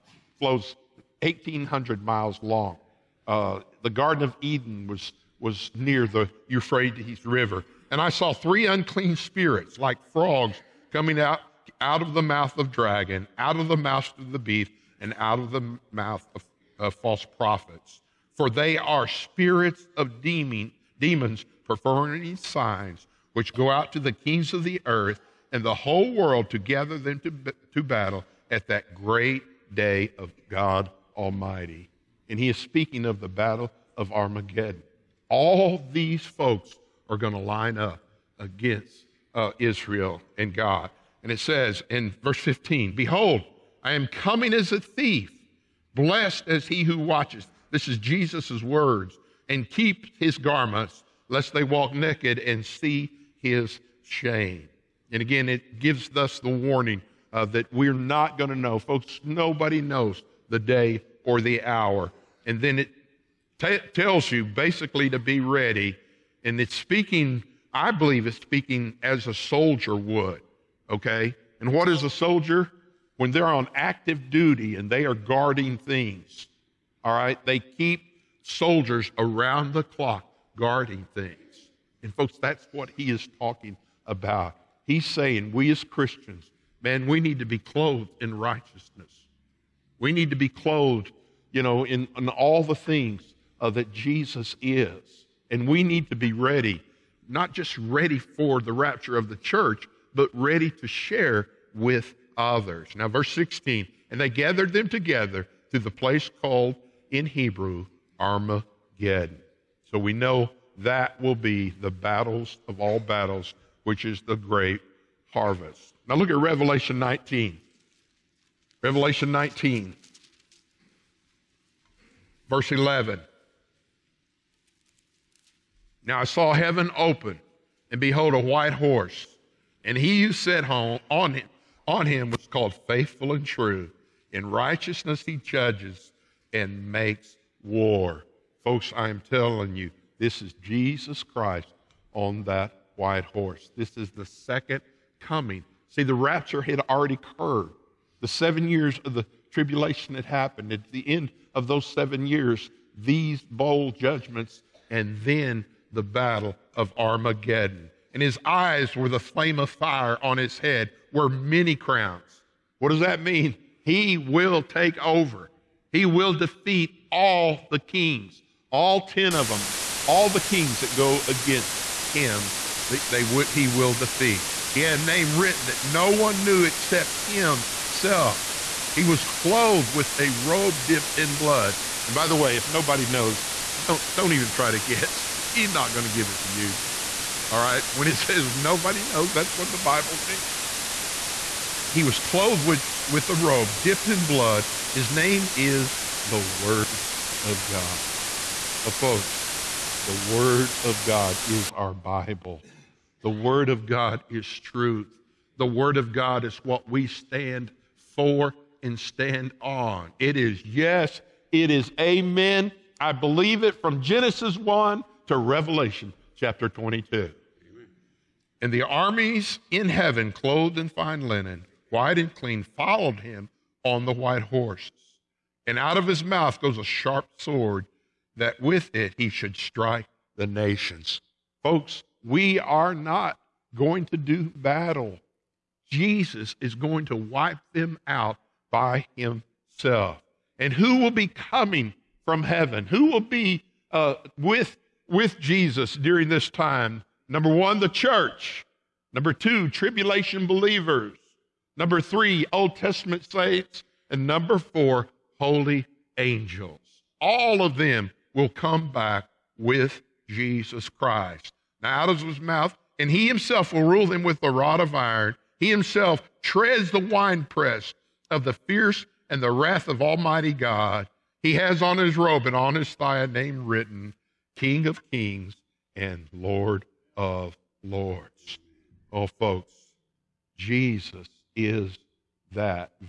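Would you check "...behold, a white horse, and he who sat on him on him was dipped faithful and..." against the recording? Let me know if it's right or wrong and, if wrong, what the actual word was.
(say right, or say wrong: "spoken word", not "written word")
wrong: "called", not "dipped".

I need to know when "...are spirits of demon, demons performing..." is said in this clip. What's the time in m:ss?
0:18.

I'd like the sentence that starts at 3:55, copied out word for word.
Jesus is going to wipe them out by himself.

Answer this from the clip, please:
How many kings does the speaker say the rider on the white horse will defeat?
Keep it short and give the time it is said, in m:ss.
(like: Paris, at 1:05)
10, at 2:48.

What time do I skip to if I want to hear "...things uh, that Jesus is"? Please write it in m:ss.
1:32.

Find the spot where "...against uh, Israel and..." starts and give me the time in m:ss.
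0:38.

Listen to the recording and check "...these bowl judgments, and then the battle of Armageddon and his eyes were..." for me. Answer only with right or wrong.
right.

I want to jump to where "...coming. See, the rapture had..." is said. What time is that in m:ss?
2:25.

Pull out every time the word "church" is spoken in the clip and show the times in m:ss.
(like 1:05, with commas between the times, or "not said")
1:39, 4:07.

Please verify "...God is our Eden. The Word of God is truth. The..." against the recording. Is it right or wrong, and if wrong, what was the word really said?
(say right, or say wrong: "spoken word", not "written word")
wrong: "Bible", not "Eden".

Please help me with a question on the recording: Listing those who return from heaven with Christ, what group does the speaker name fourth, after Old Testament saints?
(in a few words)
Holy angels.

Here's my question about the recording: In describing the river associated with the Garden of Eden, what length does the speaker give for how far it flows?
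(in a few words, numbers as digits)
1,800 miles.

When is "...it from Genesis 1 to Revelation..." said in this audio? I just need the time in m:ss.
3:33.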